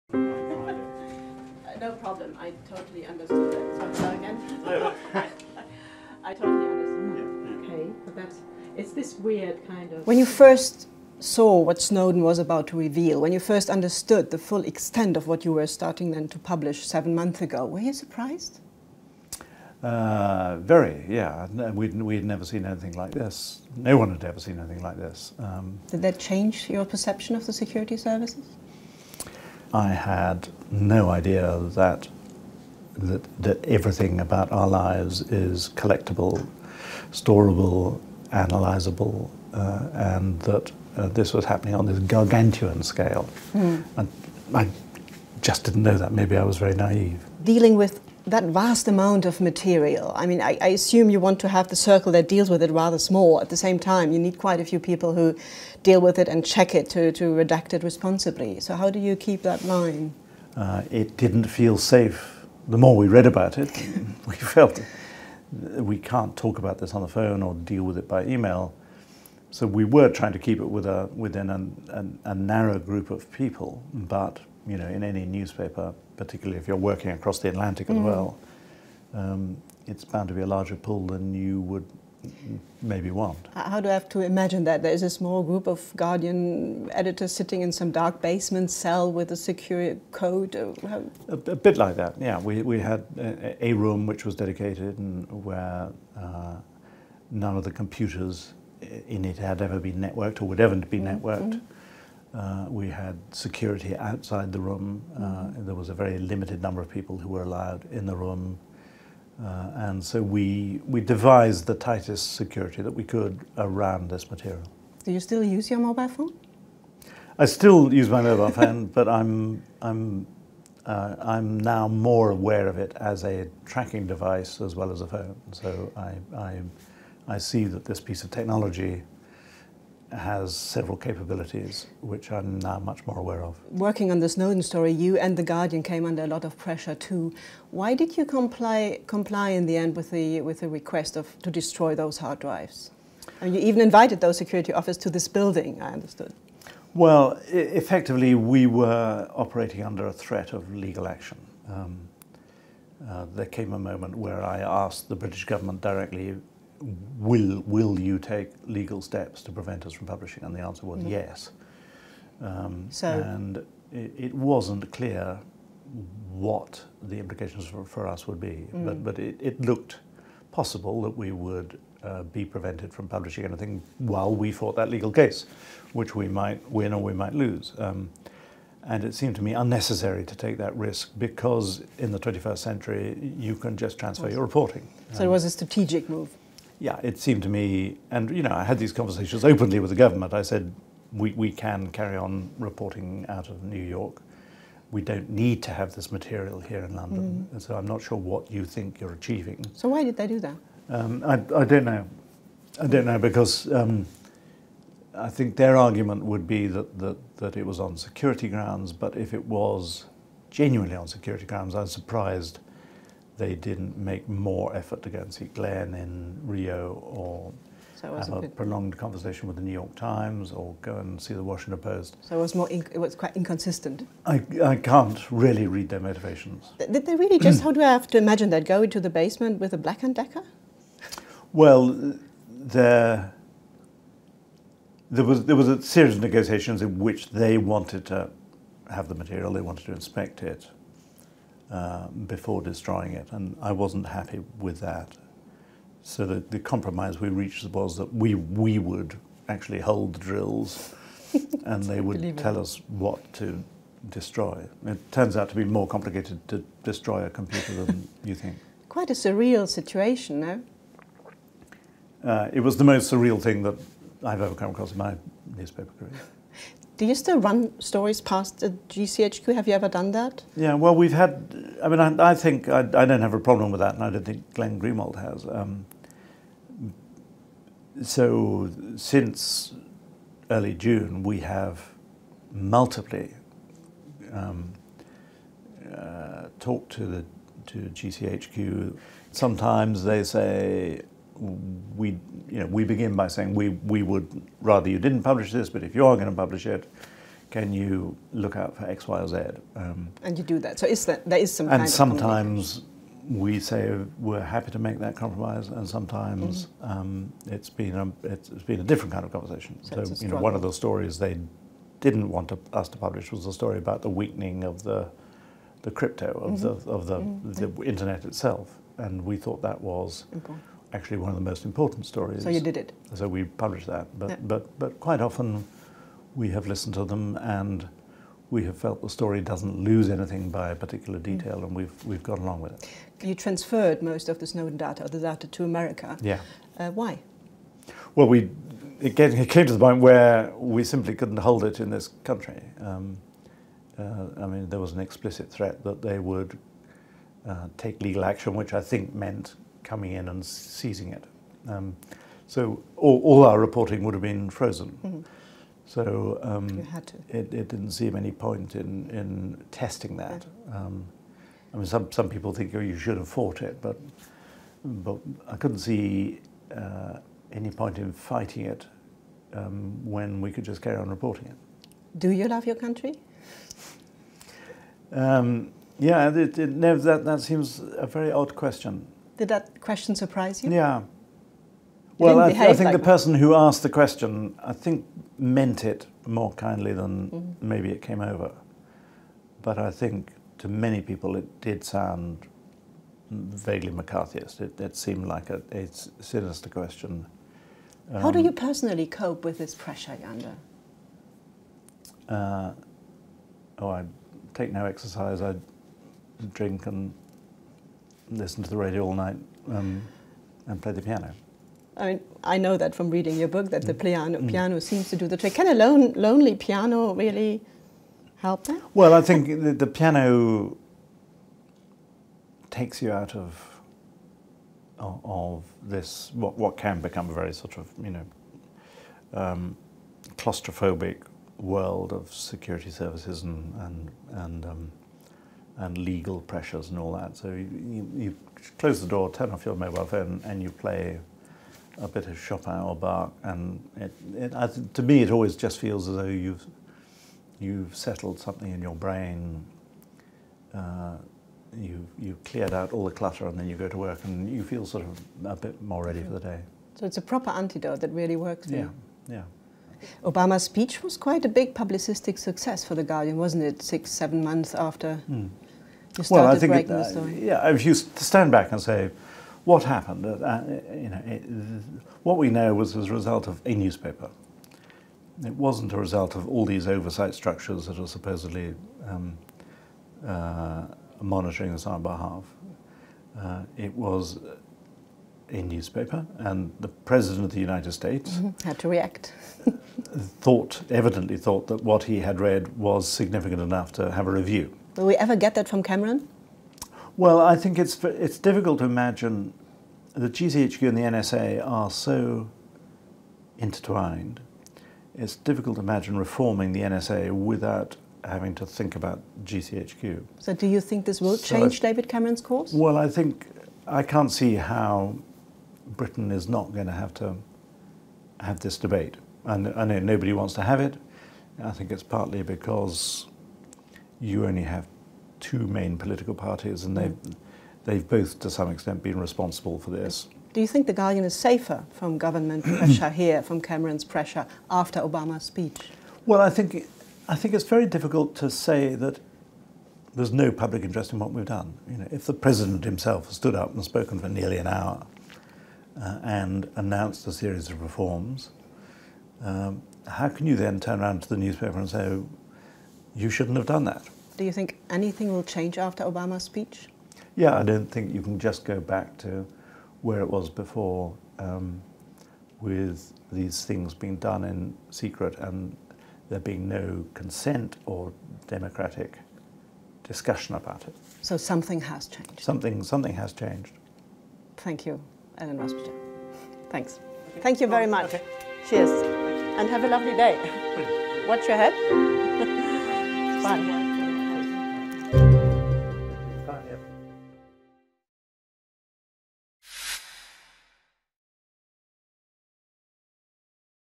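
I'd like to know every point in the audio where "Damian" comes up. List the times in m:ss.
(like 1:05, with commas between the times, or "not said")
not said.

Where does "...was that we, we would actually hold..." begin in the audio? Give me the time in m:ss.
4:07.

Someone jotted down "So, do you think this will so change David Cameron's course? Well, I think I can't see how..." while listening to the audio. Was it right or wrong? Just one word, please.
right.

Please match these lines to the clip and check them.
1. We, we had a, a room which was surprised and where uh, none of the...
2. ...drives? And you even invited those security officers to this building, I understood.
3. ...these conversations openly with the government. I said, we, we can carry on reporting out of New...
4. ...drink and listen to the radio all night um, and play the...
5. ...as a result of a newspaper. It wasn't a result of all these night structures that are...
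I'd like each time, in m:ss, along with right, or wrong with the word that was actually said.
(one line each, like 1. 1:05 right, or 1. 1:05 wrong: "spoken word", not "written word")
1. 1:32 wrong: "dedicated", not "surprised"
2. 2:22 right
3. 3:08 right
4. 6:46 right
5. 7:52 wrong: "oversight", not "night".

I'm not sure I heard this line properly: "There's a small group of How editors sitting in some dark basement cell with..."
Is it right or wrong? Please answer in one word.
wrong.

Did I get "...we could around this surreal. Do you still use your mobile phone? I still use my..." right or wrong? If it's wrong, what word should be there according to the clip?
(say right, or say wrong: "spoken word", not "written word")
wrong: "material", not "surreal".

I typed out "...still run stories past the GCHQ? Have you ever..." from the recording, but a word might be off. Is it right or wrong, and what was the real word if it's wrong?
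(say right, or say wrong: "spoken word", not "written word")
right.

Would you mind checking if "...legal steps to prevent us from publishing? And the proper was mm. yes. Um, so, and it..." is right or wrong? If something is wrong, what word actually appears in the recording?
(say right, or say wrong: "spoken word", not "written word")
wrong: "answer", not "proper".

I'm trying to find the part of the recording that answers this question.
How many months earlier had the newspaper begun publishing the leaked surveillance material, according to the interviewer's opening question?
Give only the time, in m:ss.
0:16.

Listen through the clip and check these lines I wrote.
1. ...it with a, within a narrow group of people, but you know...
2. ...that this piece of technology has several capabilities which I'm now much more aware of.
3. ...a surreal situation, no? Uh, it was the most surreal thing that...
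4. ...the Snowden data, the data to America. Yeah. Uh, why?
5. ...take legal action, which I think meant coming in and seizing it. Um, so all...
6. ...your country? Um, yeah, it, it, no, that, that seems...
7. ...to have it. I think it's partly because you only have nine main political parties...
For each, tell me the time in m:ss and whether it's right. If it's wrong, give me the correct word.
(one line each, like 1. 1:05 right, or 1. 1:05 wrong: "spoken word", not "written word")
1. 1:10 right
2. 2:07 right
3. 4:19 right
4. 5:34 right
5. 5:47 right
6. 6:12 right
7. 8:40 wrong: "two", not "nine".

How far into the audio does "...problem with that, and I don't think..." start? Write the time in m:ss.
4:33.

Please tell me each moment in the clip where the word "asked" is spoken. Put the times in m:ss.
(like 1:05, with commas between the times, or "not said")
2:34, 6:23.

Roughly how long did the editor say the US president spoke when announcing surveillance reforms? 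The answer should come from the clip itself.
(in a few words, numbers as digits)
nearly an hour.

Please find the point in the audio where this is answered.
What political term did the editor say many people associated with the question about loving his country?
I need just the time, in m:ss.
6:33.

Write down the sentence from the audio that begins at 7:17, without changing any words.
So you, you, close the door, turn off your mobile phone, and you play a bit of Chopin or Bach.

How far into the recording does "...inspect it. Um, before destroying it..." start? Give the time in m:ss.
3:59.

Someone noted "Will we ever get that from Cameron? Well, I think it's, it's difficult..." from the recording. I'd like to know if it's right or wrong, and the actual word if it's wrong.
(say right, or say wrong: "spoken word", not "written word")
right.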